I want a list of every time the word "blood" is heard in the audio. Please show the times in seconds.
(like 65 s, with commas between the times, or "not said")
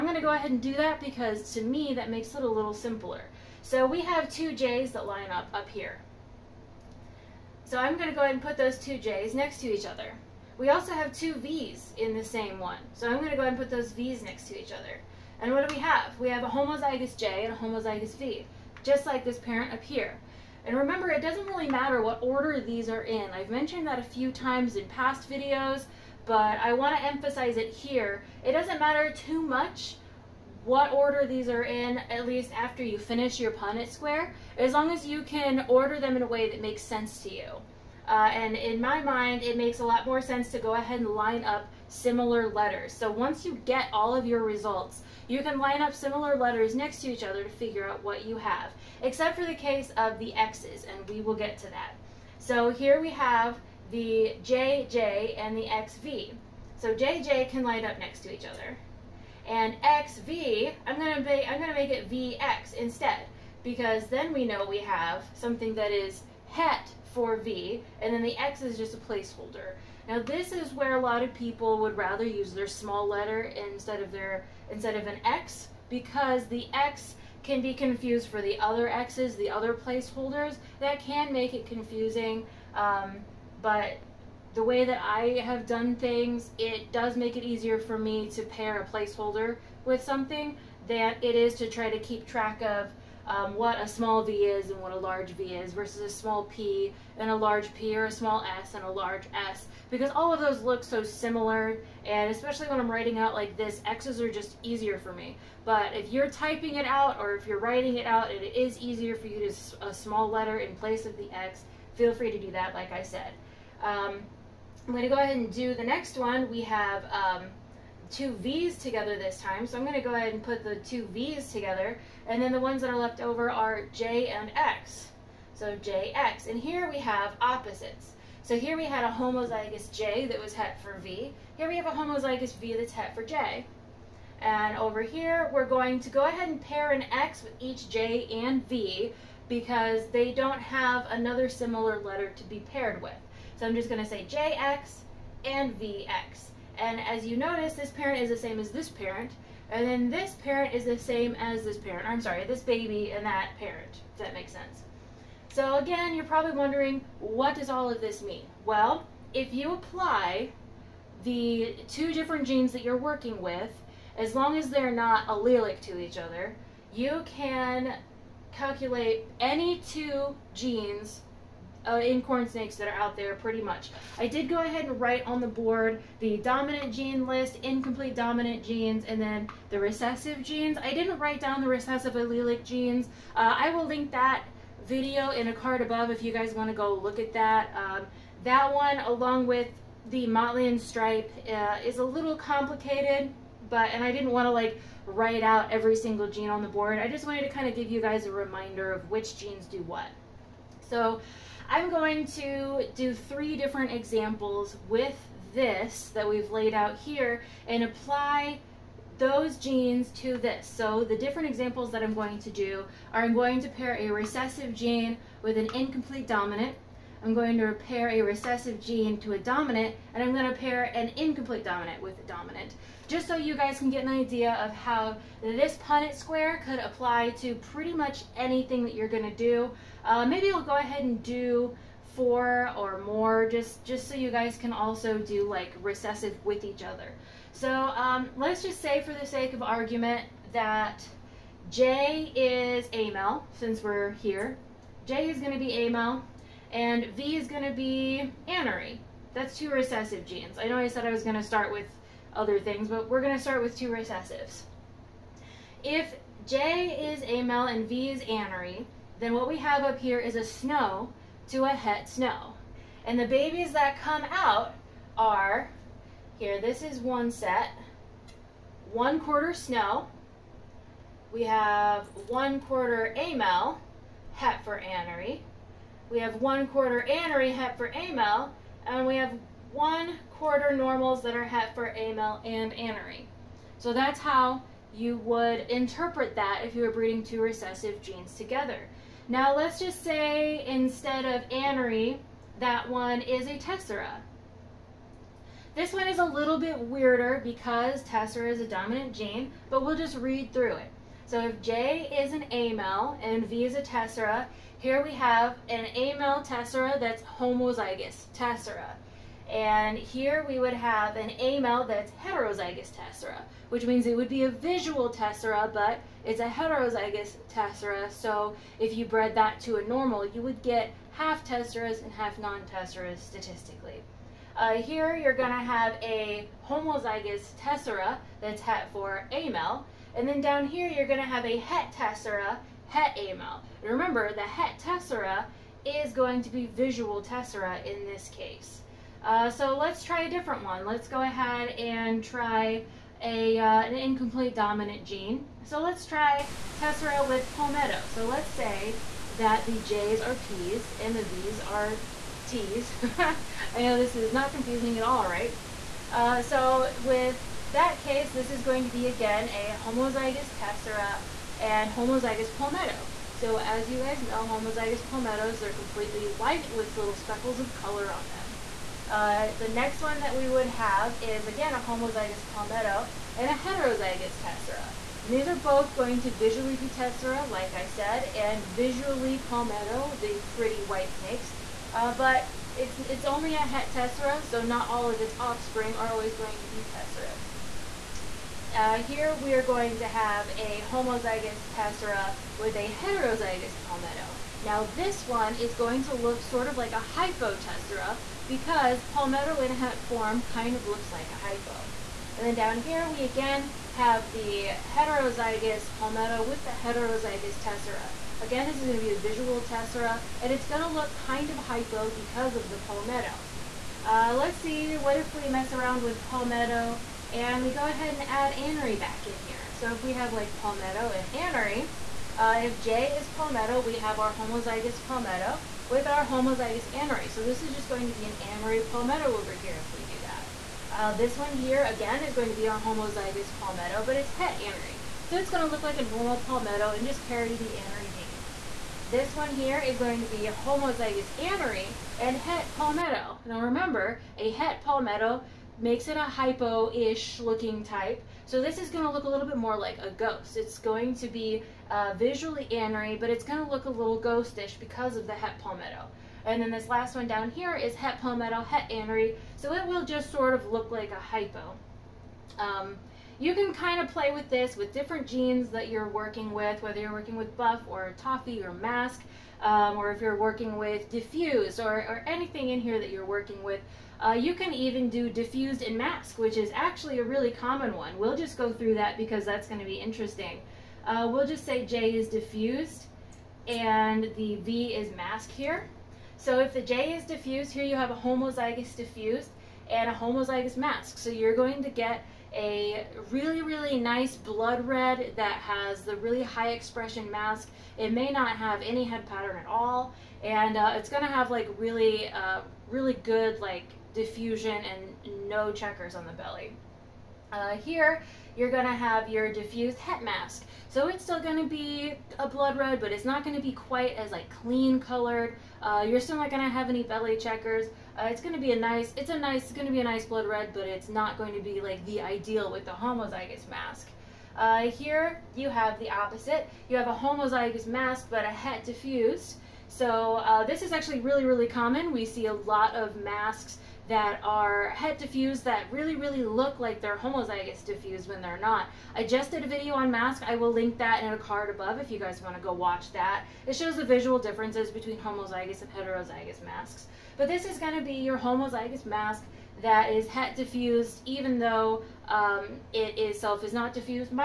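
494 s, 512 s, 520 s.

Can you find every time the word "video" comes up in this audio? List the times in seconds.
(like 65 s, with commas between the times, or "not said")
25 s, 184 s, 539 s.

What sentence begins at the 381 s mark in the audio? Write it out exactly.
Uh, but it's, it's only a het tessera, so not all of its offspring are always going to be tesseras.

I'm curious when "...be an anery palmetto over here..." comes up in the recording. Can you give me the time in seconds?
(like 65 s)
428 s.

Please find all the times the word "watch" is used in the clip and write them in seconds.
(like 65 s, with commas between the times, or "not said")
542 s.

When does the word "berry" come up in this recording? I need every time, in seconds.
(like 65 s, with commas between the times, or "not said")
not said.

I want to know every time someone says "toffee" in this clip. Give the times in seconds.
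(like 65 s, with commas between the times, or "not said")
468 s.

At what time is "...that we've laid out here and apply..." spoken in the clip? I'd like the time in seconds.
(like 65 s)
206 s.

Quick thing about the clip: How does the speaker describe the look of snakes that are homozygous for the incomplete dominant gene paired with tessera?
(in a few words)
completely white.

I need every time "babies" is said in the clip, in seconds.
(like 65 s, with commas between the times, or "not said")
263 s.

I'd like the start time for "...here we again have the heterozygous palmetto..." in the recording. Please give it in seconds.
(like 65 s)
402 s.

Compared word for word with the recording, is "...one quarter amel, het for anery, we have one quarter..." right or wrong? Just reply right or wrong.
right.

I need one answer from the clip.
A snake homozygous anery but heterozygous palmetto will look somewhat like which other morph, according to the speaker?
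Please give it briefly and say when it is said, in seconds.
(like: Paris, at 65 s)
ghost, at 449 s.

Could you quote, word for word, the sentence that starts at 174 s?
I did go ahead and write on the board the dominant gene list, incomplete dominant genes, and then the recessive genes.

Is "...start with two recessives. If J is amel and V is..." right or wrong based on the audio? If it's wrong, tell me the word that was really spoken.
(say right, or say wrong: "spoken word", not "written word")
right.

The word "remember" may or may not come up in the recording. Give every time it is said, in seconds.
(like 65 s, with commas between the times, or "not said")
20 s, 333 s, 443 s.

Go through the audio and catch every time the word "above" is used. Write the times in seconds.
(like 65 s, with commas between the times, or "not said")
185 s, 541 s.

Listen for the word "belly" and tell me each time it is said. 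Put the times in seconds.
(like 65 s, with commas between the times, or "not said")
506 s, 517 s.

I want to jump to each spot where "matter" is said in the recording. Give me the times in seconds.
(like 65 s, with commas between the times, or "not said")
21 s, 28 s.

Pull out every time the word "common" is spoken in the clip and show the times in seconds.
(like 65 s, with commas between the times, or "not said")
477 s, 531 s.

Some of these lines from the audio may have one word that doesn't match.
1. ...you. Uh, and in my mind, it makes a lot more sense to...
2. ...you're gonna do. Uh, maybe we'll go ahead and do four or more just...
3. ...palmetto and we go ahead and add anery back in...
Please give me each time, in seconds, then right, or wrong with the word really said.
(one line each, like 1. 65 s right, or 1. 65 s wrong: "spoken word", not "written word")
1. 37 s right
2. 228 s right
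3. 416 s right.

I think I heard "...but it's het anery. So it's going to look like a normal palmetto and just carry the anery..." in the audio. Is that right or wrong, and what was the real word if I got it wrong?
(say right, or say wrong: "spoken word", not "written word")
right.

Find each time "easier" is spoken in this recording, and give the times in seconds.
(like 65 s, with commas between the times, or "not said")
87 s, 104 s, 108 s.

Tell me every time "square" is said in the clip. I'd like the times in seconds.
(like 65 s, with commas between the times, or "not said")
33 s, 226 s.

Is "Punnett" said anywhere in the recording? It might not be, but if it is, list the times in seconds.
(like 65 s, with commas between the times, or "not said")
33 s, 225 s.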